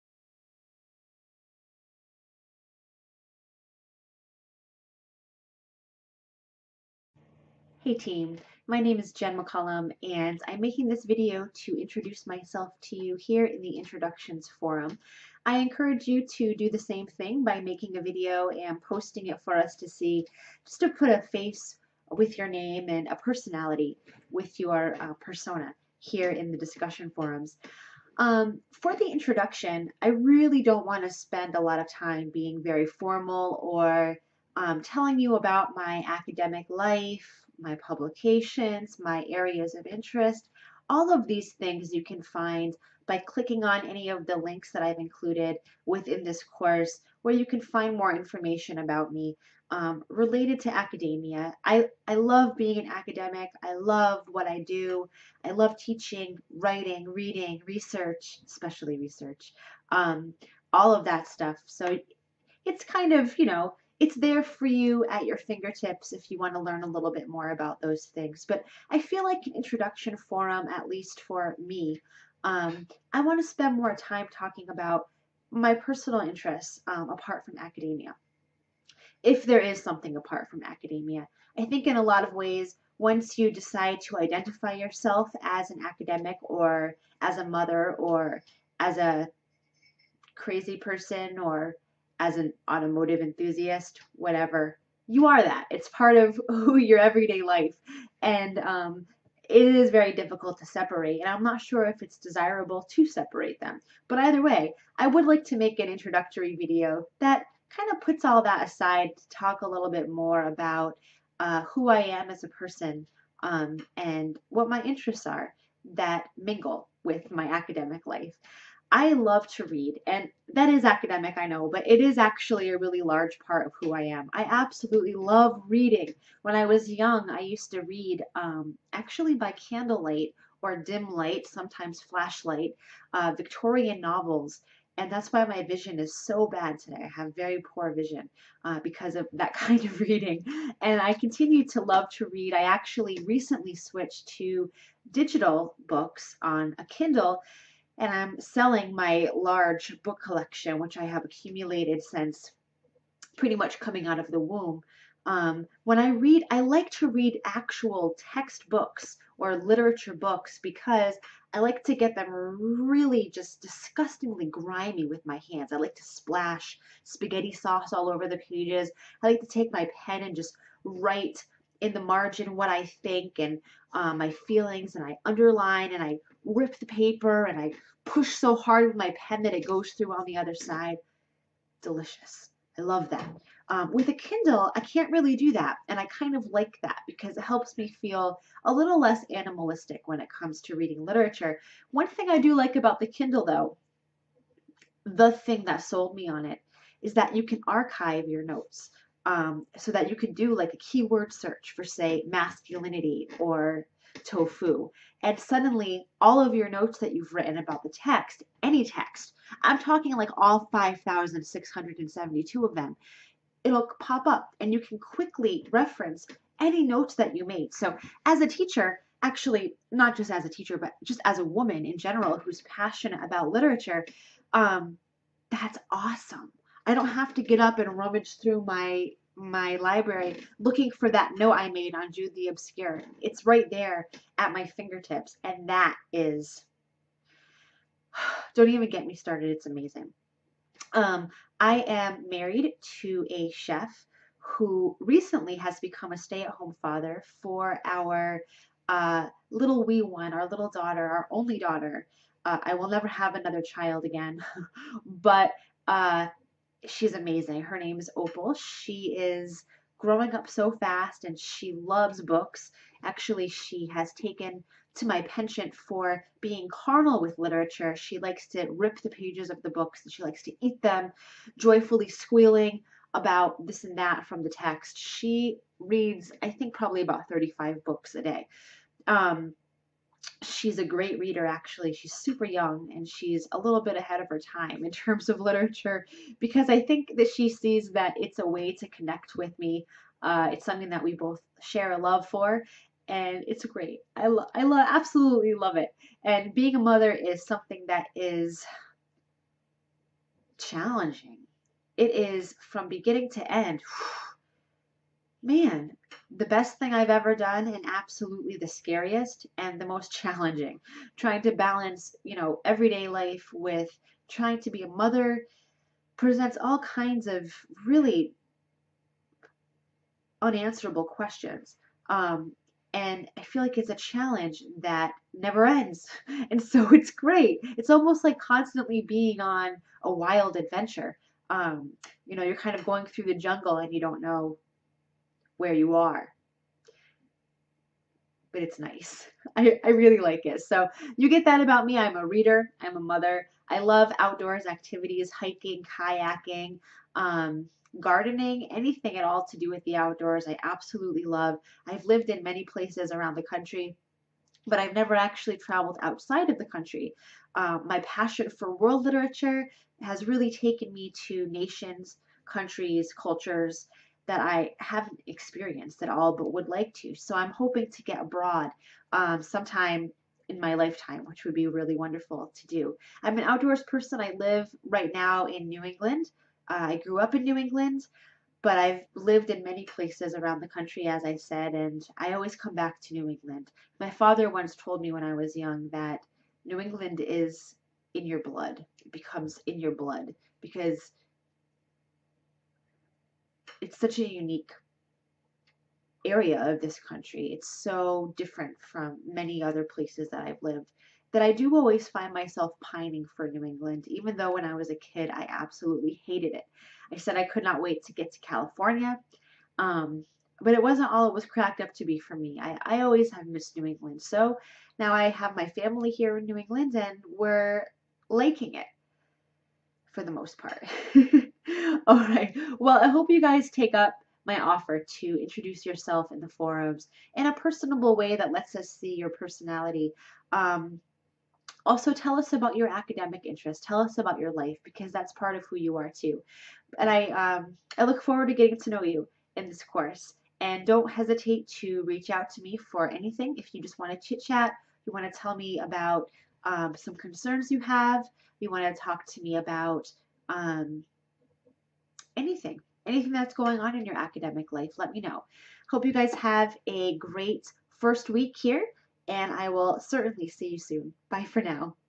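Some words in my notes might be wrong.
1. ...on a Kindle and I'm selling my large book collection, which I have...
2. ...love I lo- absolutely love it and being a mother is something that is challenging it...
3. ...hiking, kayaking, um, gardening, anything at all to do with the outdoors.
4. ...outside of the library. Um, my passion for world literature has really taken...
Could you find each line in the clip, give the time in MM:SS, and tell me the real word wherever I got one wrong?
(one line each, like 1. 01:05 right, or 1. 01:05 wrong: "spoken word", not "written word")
1. 02:26 right
2. 04:54 right
3. 05:45 right
4. 05:56 wrong: "country", not "library".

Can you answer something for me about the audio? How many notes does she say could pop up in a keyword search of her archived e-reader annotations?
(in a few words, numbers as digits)
5,672.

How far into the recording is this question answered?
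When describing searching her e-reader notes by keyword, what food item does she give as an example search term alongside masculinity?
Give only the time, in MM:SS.
03:24.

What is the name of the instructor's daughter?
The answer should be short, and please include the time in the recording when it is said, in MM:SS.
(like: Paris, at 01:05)
Opal, at 04:18.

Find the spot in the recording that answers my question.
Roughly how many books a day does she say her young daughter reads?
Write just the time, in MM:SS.
04:37.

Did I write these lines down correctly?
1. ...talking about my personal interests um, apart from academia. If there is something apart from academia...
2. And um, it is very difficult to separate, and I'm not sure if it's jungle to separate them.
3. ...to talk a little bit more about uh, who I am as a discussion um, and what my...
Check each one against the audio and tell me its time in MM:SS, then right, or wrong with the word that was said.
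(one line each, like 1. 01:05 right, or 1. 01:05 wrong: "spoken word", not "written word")
1. 01:14 right
2. 01:38 wrong: "desirable", not "jungle"
3. 01:49 wrong: "person", not "discussion".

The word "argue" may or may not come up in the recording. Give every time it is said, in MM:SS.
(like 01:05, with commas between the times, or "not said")
not said.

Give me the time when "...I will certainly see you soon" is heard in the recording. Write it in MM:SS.
07:39.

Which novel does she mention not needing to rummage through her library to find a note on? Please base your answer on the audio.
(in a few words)
Jude the Obscure.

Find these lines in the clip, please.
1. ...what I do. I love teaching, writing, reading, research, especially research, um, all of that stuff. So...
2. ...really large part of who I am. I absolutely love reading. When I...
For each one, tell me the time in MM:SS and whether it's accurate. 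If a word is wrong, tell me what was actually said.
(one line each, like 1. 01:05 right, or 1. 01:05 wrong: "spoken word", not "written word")
1. 00:54 right
2. 02:02 right.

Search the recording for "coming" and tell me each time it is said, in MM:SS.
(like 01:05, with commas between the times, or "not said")
02:33.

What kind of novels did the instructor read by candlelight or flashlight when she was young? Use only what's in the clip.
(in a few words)
Victorian novels.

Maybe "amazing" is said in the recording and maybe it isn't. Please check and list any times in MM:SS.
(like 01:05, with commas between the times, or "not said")
03:59, 04:17.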